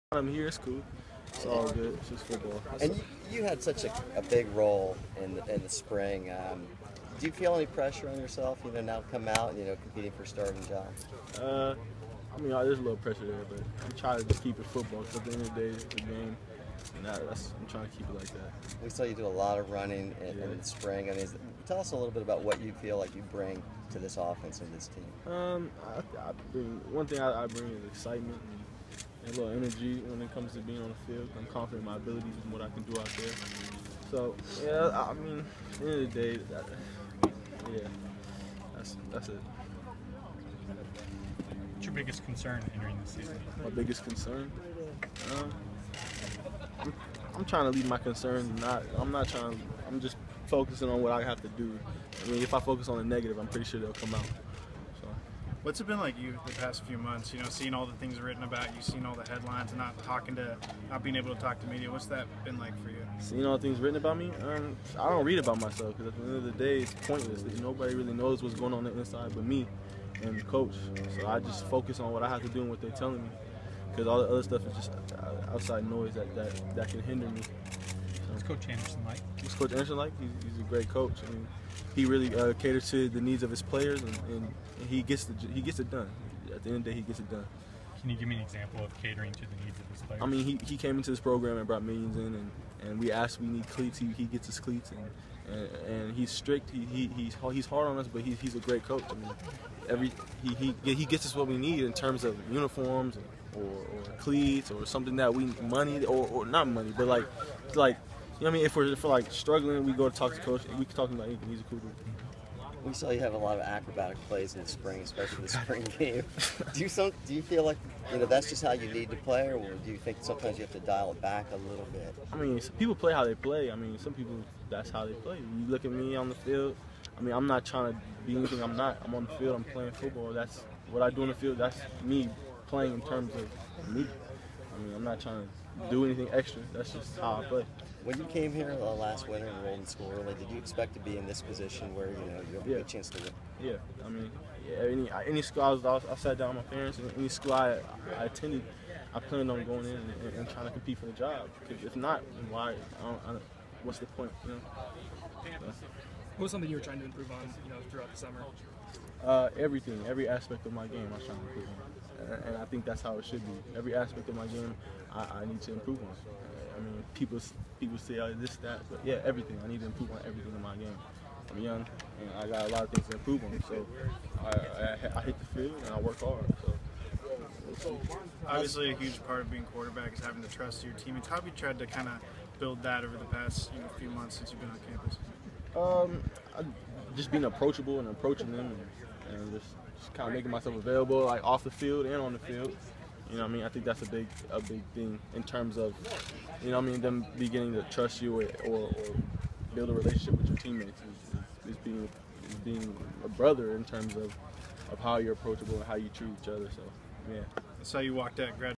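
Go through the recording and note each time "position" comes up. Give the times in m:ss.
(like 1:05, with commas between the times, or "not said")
2:21.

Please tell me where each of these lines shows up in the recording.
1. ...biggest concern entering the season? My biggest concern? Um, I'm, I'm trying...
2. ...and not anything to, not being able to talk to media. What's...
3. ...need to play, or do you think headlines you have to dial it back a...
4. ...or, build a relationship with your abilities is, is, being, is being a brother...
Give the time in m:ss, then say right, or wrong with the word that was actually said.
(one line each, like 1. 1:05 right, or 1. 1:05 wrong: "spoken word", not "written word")
1. 0:41 right
2. 0:59 wrong: "talking", not "anything"
3. 1:58 wrong: "sometimes", not "headlines"
4. 3:18 wrong: "teammates", not "abilities".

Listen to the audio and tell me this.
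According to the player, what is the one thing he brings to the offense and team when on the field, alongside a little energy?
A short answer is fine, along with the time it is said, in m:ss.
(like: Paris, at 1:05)
Excitement, at 0:27.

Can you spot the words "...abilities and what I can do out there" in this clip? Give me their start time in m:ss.
0:31.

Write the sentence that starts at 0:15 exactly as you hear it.
Cause at the end of the day, it's the game.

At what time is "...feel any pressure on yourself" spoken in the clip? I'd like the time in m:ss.
0:07.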